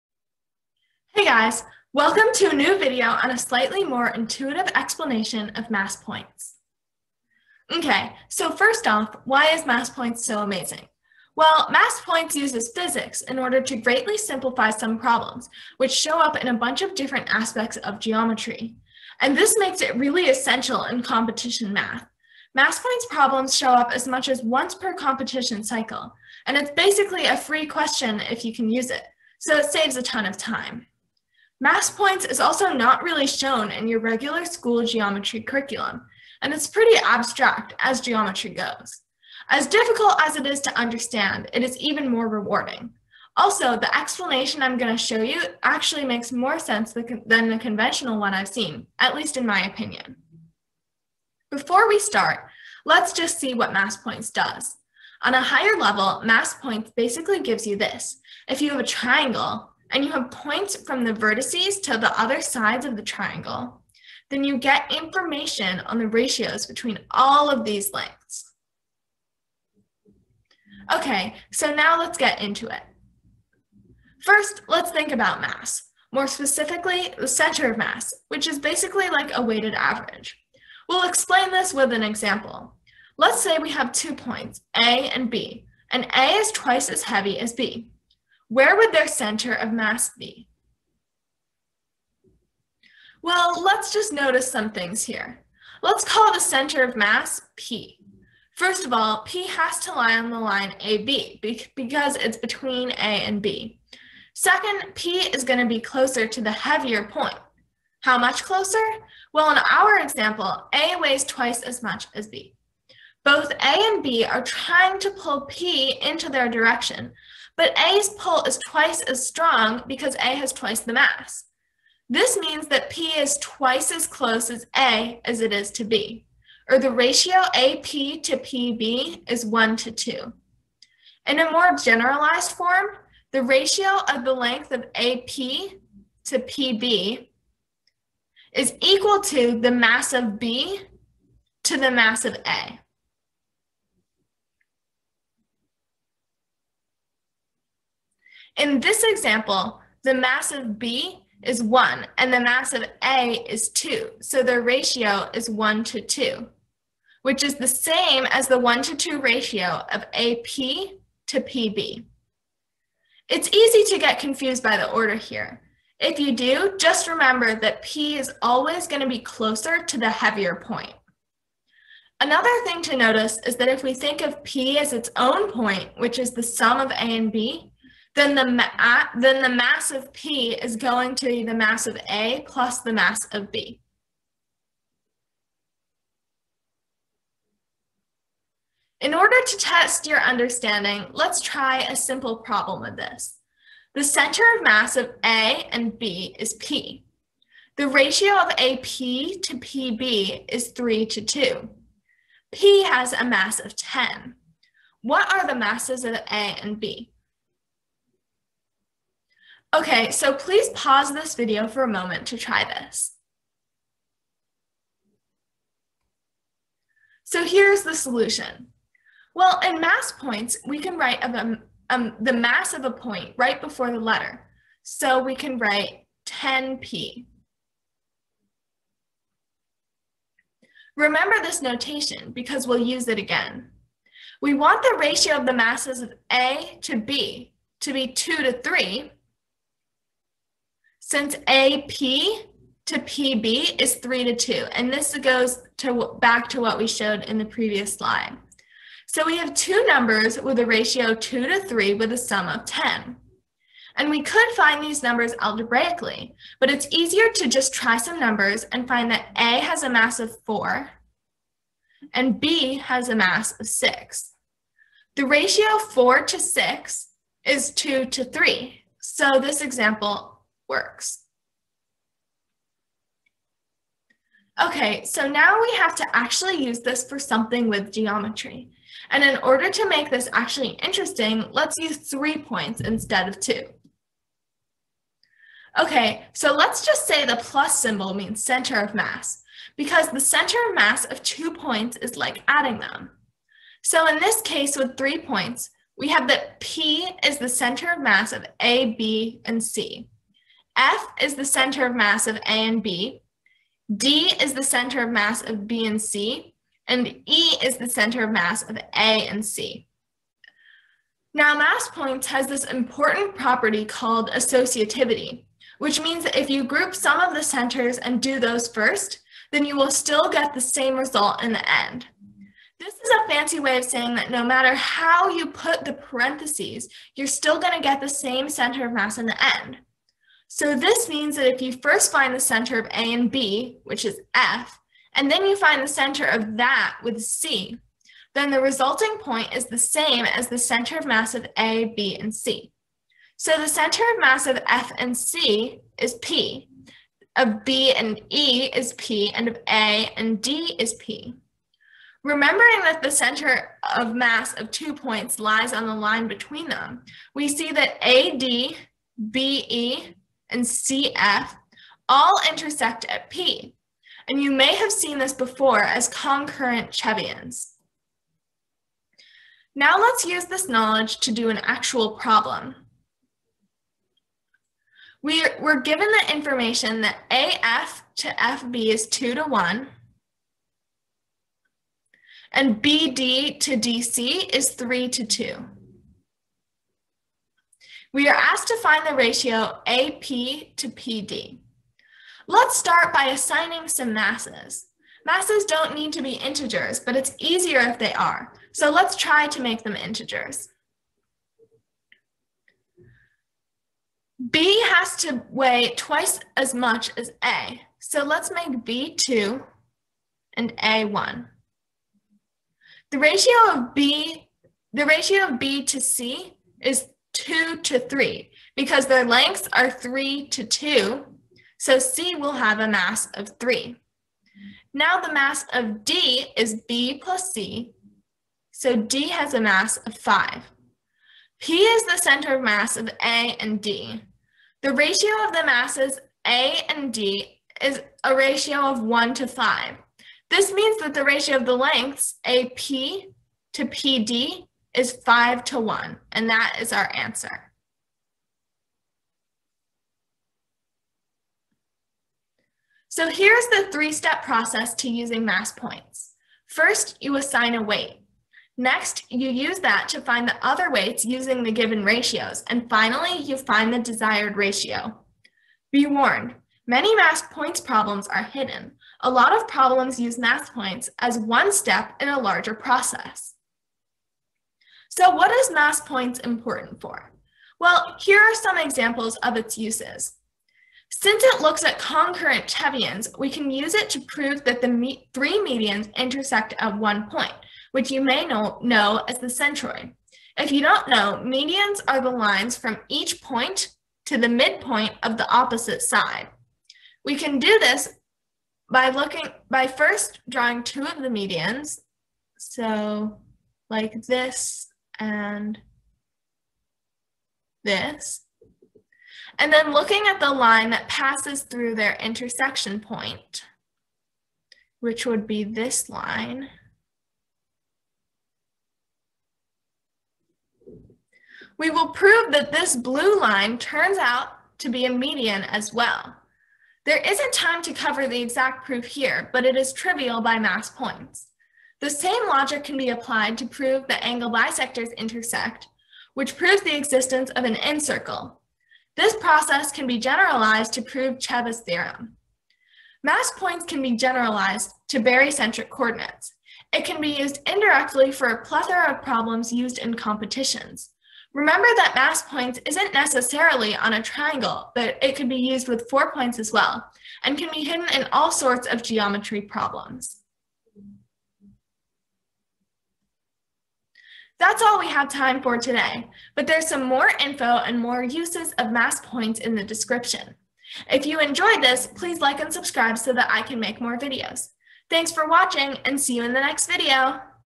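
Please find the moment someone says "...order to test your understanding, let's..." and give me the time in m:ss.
3:09.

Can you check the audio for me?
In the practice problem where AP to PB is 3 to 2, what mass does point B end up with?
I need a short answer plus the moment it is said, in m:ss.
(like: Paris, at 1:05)
6, at 4:22.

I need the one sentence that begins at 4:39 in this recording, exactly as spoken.
And in order to make this actually interesting, let's use three points instead of two.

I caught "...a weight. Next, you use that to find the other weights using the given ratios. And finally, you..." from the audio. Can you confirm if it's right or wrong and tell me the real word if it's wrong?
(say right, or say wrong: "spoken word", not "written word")
right.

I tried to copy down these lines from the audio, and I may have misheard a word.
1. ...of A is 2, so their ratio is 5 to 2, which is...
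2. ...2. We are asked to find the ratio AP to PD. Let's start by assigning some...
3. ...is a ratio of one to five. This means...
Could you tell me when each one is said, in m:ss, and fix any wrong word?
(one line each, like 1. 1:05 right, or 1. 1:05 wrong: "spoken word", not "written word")
1. 2:32 wrong: "1", not "5"
2. 6:25 right
3. 7:17 right.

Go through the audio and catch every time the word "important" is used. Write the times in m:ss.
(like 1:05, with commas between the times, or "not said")
5:12, 7:56.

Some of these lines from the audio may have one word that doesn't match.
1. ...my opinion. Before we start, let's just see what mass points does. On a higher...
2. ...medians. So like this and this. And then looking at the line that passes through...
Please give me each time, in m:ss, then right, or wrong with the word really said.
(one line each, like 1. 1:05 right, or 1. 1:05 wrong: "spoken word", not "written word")
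1. 0:49 right
2. 8:21 right.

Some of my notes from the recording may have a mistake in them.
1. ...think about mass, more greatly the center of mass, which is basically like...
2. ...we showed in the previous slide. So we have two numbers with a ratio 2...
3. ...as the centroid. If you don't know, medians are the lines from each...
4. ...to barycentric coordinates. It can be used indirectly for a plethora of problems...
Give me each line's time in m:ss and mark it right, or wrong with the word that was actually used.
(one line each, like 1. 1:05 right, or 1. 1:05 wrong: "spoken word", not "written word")
1. 1:14 wrong: "specifically", not "greatly"
2. 4:06 right
3. 8:09 right
4. 9:05 right.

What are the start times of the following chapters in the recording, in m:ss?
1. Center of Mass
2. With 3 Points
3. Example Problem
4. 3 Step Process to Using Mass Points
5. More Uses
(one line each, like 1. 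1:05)
1. 1:13
2. 4:33
3. 6:08
4. 7:32
5. 7:54.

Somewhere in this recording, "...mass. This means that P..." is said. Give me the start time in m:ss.
2:00.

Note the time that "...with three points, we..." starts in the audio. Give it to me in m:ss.
4:54.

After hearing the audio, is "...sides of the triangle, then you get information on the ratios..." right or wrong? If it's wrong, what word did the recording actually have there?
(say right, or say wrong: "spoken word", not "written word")
right.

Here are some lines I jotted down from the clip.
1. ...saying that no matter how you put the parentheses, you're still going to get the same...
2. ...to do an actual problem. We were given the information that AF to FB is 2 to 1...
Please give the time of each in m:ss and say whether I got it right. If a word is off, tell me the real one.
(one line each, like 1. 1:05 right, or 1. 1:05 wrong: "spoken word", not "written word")
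1. 5:23 right
2. 6:11 right.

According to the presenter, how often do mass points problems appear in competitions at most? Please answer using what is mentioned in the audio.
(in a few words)
once per competition cycle.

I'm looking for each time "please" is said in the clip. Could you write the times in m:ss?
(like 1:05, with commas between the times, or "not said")
3:30, 9:32.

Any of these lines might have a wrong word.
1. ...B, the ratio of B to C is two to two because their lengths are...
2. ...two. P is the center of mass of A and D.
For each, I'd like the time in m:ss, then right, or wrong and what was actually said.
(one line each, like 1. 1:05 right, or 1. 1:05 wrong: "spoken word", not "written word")
1. 6:53 wrong: "three", not "two"
2. 7:10 wrong: "five", not "two".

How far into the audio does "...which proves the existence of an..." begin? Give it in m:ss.
8:56.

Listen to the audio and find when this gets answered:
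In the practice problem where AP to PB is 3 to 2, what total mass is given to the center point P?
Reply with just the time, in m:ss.
3:22.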